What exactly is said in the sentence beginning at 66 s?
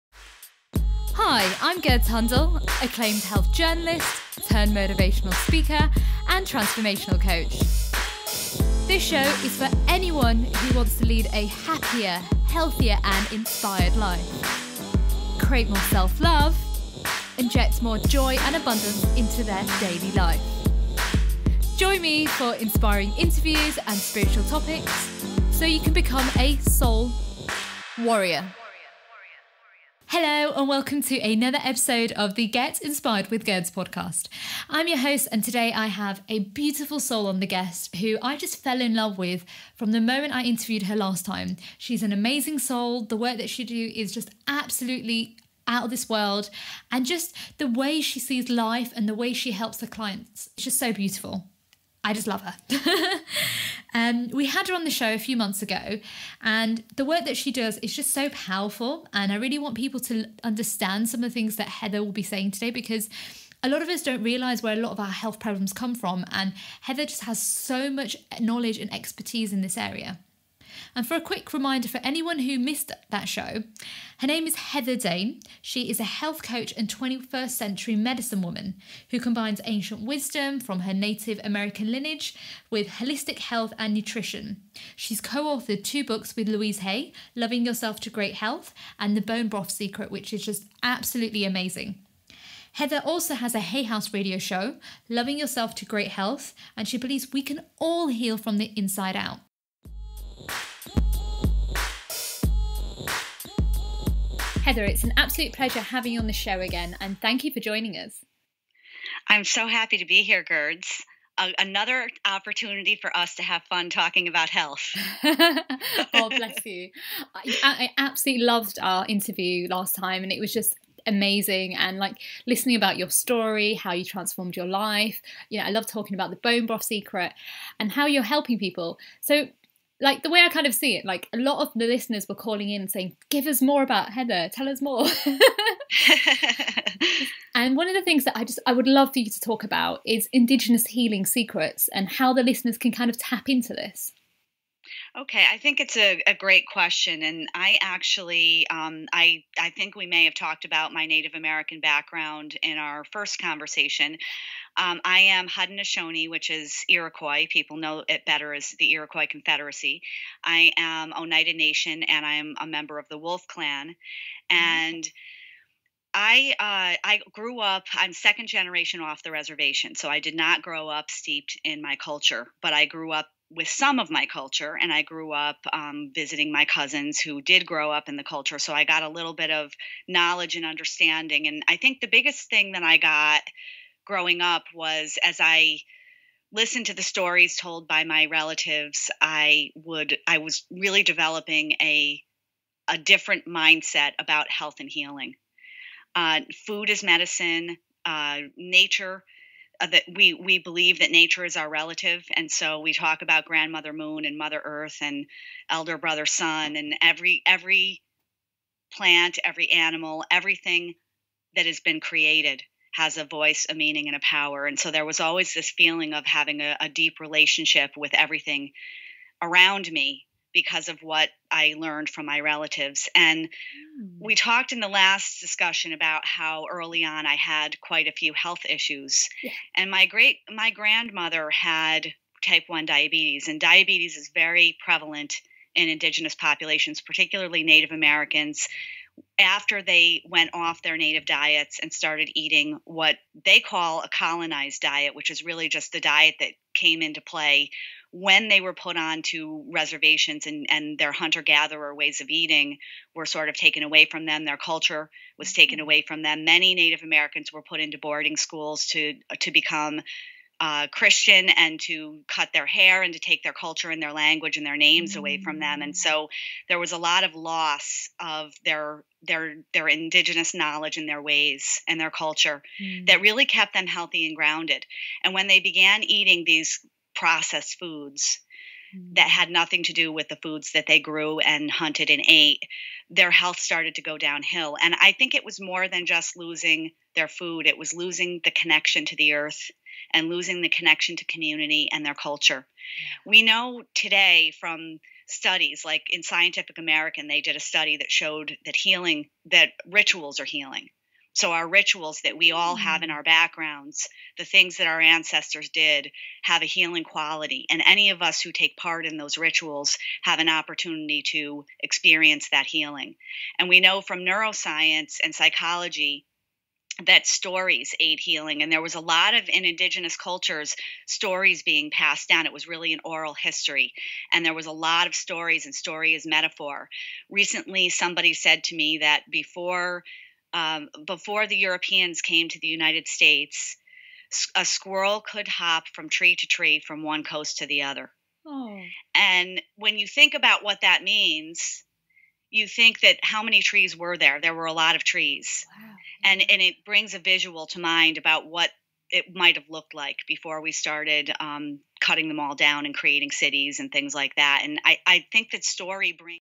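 And Heather just has so much knowledge and expertise in this area.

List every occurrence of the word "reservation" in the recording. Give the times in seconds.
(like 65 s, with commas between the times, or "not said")
169 s, 249 s.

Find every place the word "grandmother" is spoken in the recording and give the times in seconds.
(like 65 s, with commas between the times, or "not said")
203 s, 230 s.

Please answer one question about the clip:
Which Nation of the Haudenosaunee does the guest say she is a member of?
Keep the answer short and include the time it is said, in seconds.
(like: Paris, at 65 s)
Oneida, at 161 s.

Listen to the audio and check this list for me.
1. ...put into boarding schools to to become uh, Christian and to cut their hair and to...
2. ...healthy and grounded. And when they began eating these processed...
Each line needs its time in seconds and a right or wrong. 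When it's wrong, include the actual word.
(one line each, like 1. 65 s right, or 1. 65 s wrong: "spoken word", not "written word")
1. 257 s right
2. 273 s right.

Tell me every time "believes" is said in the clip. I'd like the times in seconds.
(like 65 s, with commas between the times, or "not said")
96 s, 200 s.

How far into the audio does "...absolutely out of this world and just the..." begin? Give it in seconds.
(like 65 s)
44 s.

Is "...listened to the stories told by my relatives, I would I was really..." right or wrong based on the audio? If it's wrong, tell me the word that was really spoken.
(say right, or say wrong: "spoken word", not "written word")
right.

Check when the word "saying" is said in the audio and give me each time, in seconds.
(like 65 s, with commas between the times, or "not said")
62 s, 132 s.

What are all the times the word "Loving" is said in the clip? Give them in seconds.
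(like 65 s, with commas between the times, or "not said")
87 s, 95 s.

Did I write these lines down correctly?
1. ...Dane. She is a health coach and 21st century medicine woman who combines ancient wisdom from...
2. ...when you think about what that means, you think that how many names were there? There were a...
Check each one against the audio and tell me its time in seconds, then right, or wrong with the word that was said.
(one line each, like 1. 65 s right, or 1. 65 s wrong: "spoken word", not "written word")
1. 74 s right
2. 339 s wrong: "trees", not "names".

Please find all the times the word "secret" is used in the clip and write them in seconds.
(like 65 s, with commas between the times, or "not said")
89 s, 126 s, 141 s.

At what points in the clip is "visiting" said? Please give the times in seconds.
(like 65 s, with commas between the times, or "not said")
176 s.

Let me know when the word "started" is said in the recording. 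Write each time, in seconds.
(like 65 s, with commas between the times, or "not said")
241 s, 283 s, 350 s.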